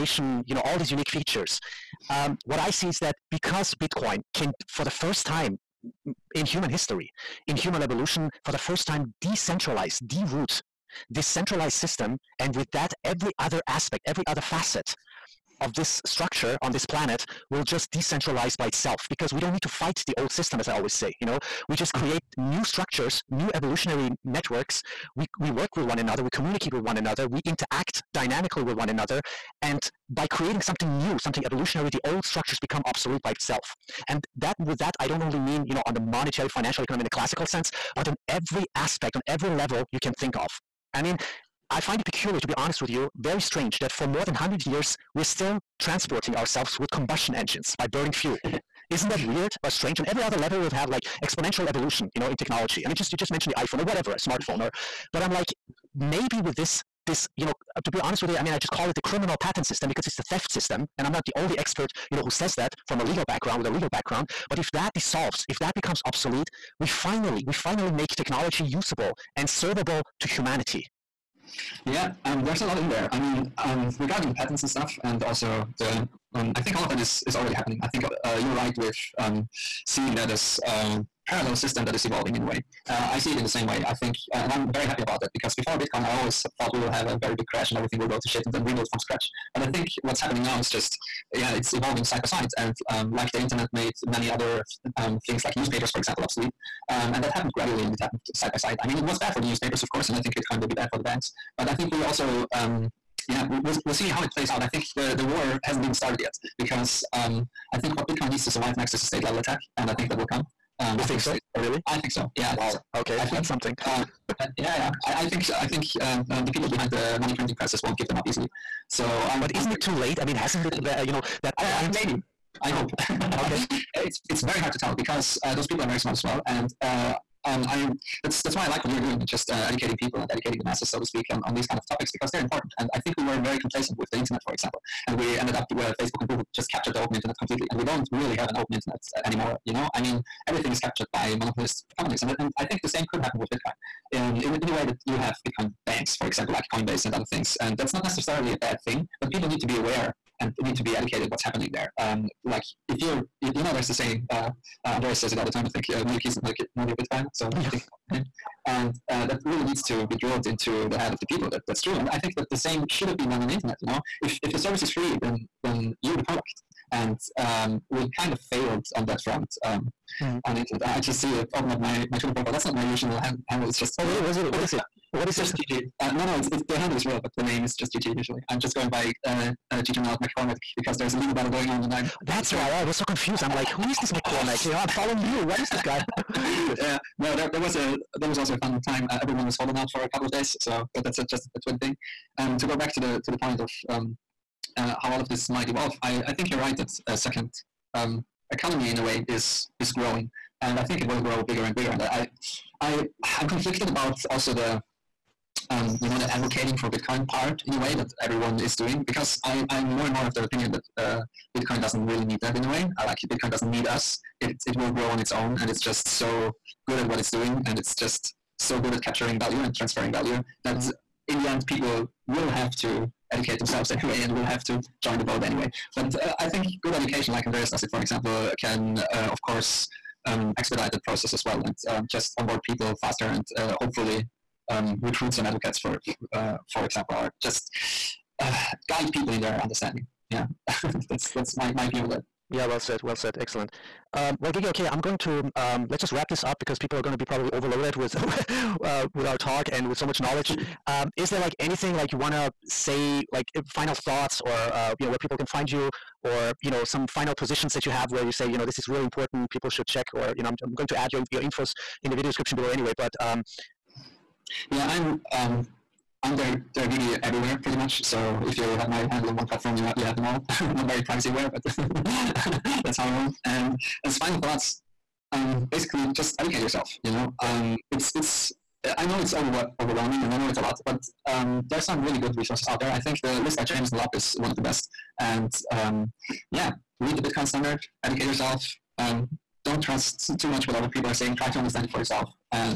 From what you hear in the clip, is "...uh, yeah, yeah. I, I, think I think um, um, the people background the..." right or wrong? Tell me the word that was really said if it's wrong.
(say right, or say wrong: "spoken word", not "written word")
wrong: "behind", not "background".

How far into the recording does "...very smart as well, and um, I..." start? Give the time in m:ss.
2:05.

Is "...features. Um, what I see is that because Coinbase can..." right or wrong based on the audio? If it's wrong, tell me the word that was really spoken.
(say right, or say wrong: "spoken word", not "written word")
wrong: "Bitcoin", not "Coinbase".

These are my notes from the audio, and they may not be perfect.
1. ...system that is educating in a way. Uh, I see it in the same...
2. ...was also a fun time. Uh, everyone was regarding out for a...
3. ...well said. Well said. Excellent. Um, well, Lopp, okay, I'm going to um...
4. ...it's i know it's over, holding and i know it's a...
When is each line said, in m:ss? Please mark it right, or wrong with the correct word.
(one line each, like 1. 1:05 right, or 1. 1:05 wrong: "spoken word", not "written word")
1. 1:21 wrong: "evolving", not "educating"
2. 3:08 wrong: "holding", not "regarding"
3. 4:02 wrong: "Gigi", not "Lopp"
4. 4:38 wrong: "overwhelming", not "holding".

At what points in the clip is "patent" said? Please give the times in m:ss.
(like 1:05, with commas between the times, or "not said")
0:59, 1:14.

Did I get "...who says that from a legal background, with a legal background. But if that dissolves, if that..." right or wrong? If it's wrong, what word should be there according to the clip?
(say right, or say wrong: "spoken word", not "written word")
right.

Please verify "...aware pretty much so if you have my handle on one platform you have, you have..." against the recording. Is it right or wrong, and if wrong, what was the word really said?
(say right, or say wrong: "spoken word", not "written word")
wrong: "everywhere", not "aware".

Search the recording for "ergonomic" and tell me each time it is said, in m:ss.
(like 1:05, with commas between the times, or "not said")
not said.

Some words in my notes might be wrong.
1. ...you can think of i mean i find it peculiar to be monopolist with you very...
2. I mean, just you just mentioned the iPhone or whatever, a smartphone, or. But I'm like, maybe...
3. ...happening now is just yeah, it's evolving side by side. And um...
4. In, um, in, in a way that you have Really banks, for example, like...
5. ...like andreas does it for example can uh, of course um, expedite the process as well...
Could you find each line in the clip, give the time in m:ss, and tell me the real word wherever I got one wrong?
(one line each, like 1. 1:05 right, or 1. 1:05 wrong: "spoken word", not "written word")
1. 0:39 wrong: "honest", not "monopolist"
2. 0:52 right
3. 1:30 right
4. 2:24 wrong: "Bitcoin", not "Really"
5. 3:47 right.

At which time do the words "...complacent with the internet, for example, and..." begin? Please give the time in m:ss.
2:13.